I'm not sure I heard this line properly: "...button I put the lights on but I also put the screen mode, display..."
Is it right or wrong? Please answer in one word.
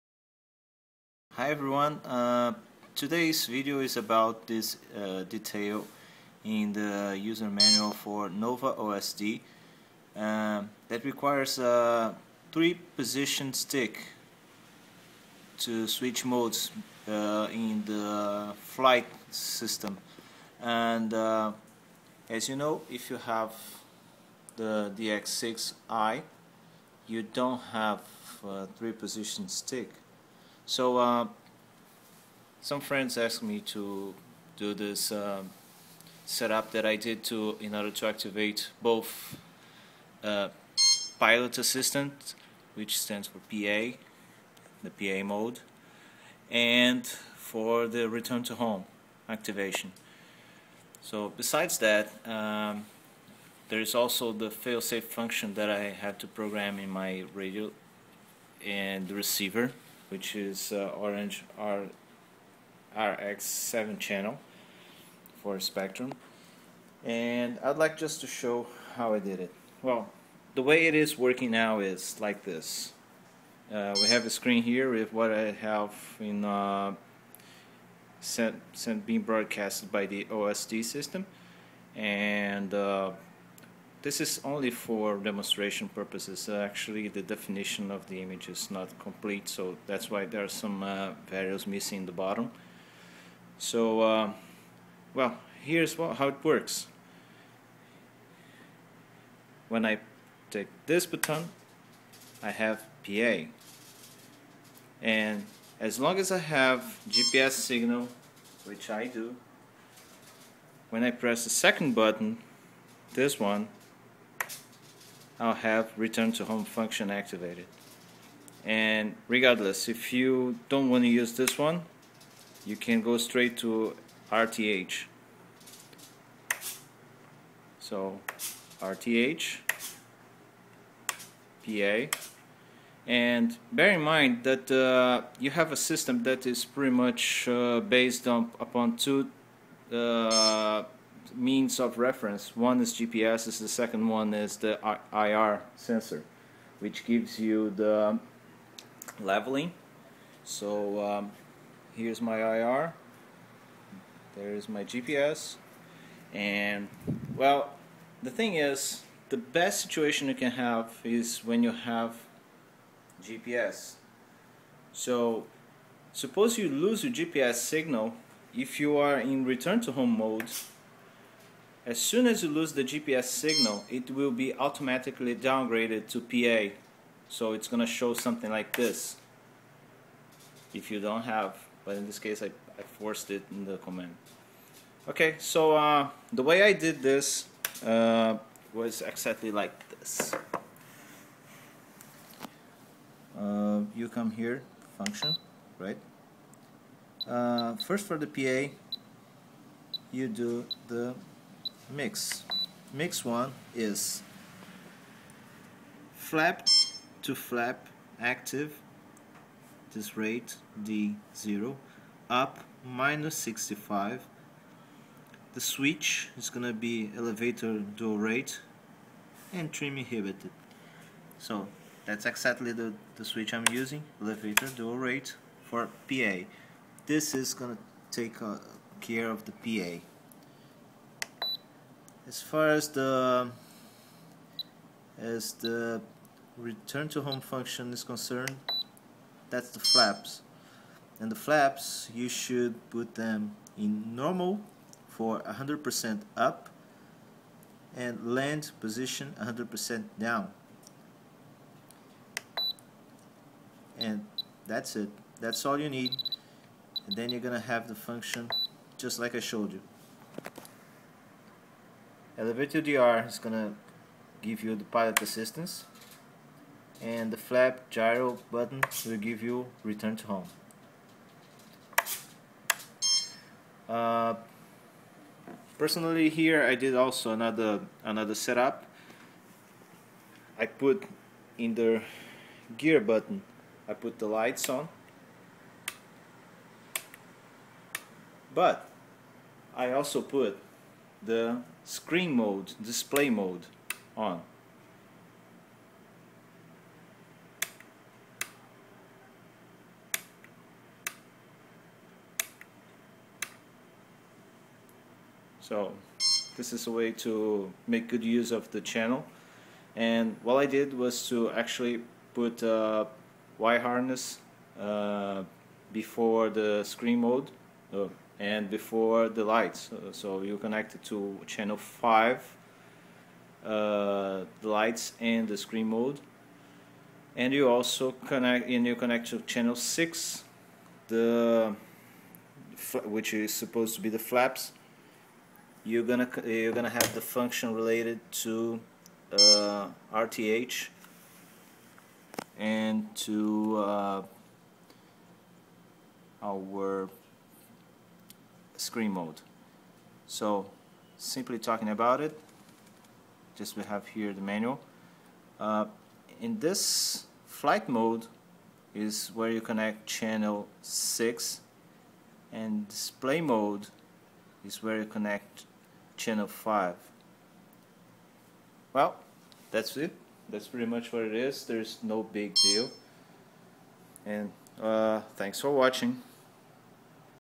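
right.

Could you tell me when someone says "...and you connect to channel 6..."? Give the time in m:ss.
5:28.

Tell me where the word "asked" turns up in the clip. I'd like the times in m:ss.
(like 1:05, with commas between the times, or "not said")
0:33.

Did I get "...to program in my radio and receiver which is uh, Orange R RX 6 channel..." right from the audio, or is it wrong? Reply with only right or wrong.
wrong.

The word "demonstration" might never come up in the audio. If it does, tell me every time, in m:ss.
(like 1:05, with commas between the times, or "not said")
1:25.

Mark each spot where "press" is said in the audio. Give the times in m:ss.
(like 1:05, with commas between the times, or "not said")
1:51.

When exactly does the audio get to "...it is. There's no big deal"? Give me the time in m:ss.
6:11.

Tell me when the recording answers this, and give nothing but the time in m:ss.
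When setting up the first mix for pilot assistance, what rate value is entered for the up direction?
3:32.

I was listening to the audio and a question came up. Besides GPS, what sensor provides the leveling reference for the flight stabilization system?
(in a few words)
IR sensor.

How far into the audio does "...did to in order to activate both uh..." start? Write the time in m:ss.
0:36.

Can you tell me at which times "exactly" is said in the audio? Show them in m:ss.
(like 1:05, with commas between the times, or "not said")
3:09, 3:42.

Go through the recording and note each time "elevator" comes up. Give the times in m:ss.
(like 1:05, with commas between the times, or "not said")
3:37, 3:44, 4:22.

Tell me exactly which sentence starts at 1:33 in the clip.
So, uh, well, here's what, how it works.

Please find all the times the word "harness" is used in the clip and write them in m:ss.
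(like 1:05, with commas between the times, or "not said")
5:13.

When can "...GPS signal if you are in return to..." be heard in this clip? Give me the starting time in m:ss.
2:47.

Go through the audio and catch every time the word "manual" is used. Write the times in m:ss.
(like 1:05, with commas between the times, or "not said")
0:07, 5:54.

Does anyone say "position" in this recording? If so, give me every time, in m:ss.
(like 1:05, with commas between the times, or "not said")
0:12, 0:28, 4:08.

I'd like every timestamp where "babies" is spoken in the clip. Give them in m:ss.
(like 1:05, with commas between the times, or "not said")
not said.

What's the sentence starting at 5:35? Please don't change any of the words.
You're gonna you're gonna have the function related to uh, RTH and to uh, our screen mode.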